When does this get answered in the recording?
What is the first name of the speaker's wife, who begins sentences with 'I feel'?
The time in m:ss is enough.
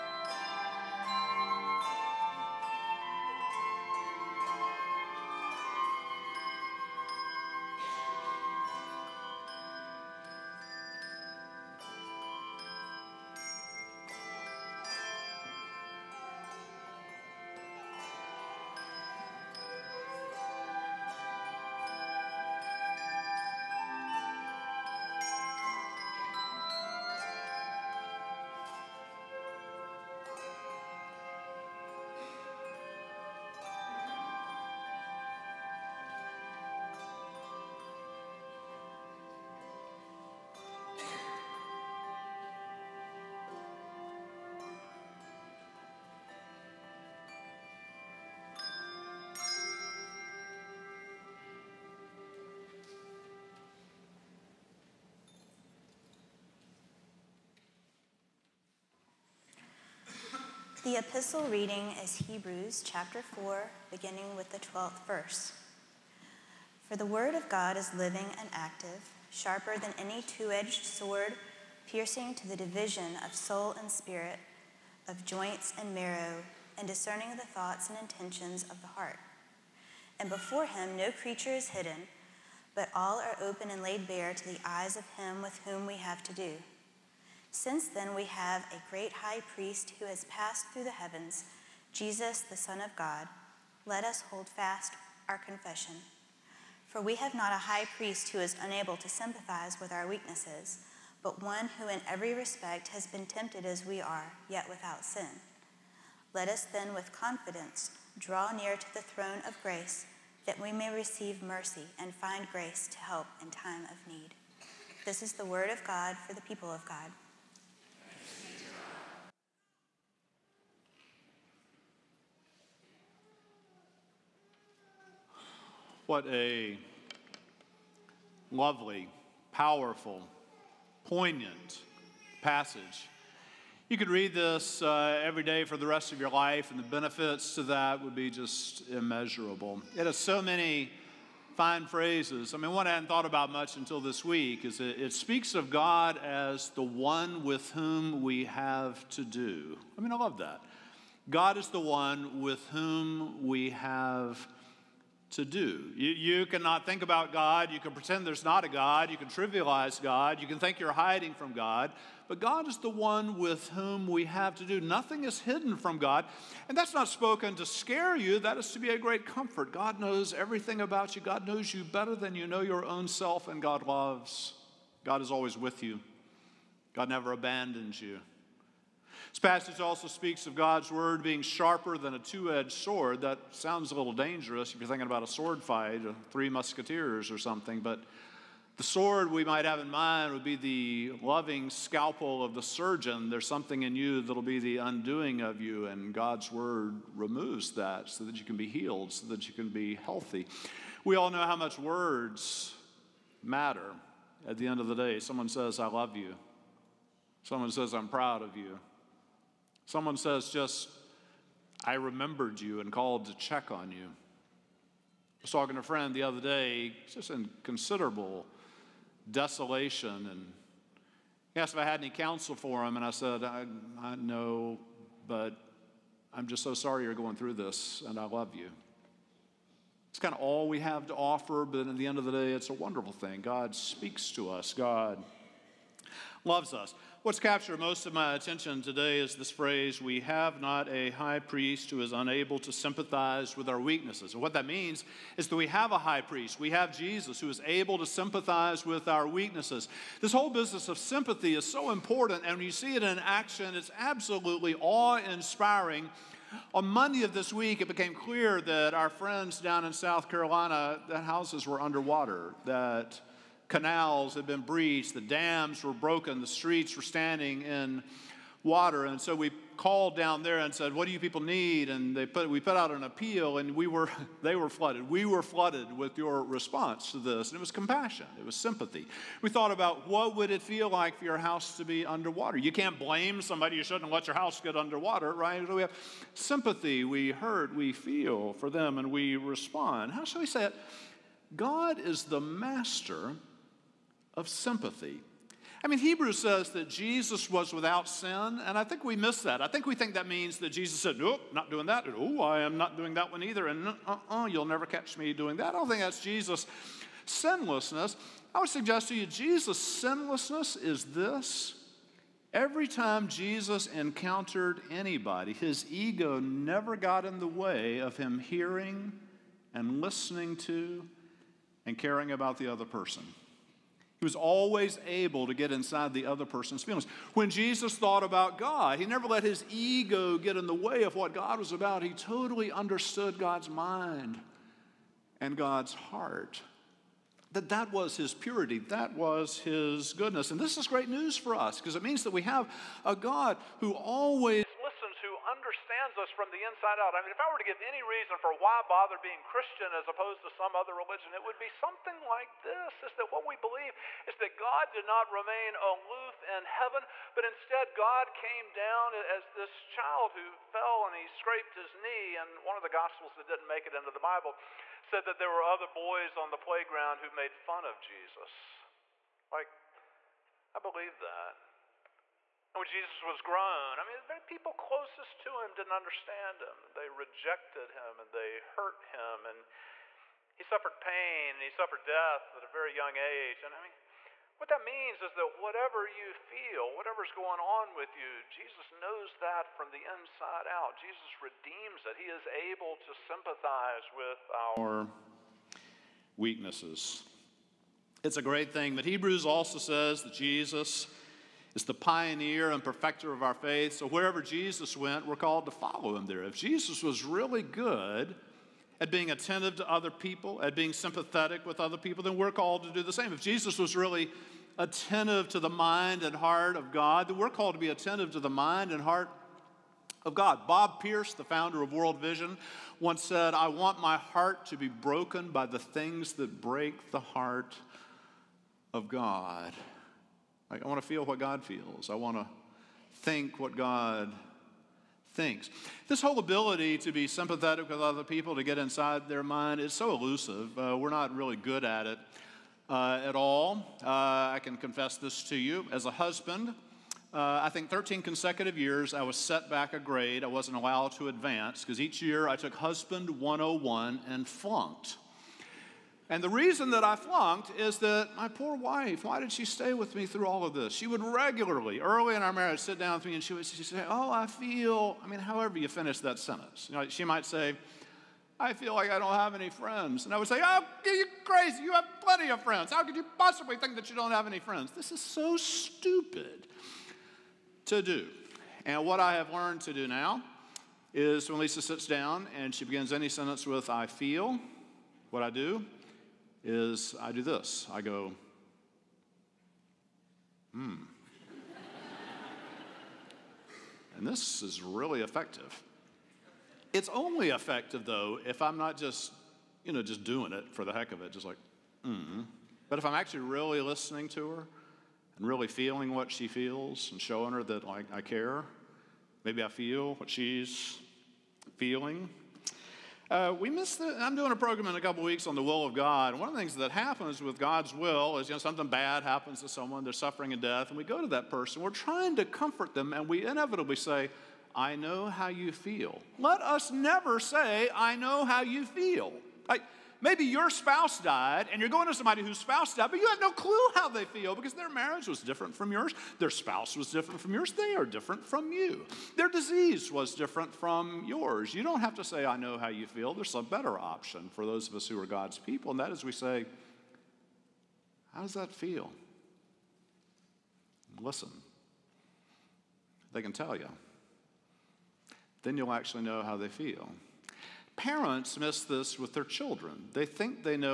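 8:01.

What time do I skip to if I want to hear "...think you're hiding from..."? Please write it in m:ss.
2:40.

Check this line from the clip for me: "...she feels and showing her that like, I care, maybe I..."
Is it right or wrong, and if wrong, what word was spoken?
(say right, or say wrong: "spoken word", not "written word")
right.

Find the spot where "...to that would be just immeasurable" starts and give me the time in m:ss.
2:17.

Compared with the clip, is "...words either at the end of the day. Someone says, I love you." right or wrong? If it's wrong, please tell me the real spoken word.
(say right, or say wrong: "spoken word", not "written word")
wrong: "matter", not "either".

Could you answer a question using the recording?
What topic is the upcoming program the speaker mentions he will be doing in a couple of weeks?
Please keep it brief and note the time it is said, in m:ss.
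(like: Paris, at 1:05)
the will of God, at 8:35.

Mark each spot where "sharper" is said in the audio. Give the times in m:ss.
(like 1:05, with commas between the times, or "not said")
1:09, 3:01.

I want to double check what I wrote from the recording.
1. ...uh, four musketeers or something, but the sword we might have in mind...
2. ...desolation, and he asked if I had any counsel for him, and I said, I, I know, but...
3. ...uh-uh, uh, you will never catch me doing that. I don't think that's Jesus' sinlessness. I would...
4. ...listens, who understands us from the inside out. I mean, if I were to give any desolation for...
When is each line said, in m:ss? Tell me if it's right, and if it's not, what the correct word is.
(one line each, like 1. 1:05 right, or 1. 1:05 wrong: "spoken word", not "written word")
1. 3:06 wrong: "three", not "four"
2. 3:39 right
3. 5:04 right
4. 5:44 wrong: "reason", not "desolation".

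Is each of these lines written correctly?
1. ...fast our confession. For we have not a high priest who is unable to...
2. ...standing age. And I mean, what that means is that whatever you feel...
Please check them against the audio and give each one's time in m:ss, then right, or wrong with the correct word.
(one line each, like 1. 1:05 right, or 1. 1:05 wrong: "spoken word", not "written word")
1. 1:34 right
2. 6:22 wrong: "young", not "standing".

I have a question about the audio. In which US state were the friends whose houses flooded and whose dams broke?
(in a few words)
South Carolina.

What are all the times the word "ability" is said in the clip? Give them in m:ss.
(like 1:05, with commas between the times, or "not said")
7:16.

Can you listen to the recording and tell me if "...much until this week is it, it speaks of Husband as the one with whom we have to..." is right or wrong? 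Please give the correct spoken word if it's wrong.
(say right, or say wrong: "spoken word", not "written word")
wrong: "God", not "Husband".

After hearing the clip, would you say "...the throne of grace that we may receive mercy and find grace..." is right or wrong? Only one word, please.
right.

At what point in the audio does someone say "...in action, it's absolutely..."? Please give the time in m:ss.
4:13.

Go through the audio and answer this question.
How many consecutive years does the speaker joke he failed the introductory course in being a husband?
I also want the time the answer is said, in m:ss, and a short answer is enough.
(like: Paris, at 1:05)
13, at 7:27.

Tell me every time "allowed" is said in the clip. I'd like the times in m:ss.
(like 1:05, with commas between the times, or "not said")
7:30.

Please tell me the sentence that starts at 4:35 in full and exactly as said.
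We were flooded with your response to this, and it was compassion.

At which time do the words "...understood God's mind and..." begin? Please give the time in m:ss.
5:32.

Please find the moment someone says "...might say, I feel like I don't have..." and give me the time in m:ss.
7:47.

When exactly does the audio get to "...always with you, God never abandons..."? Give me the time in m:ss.
2:55.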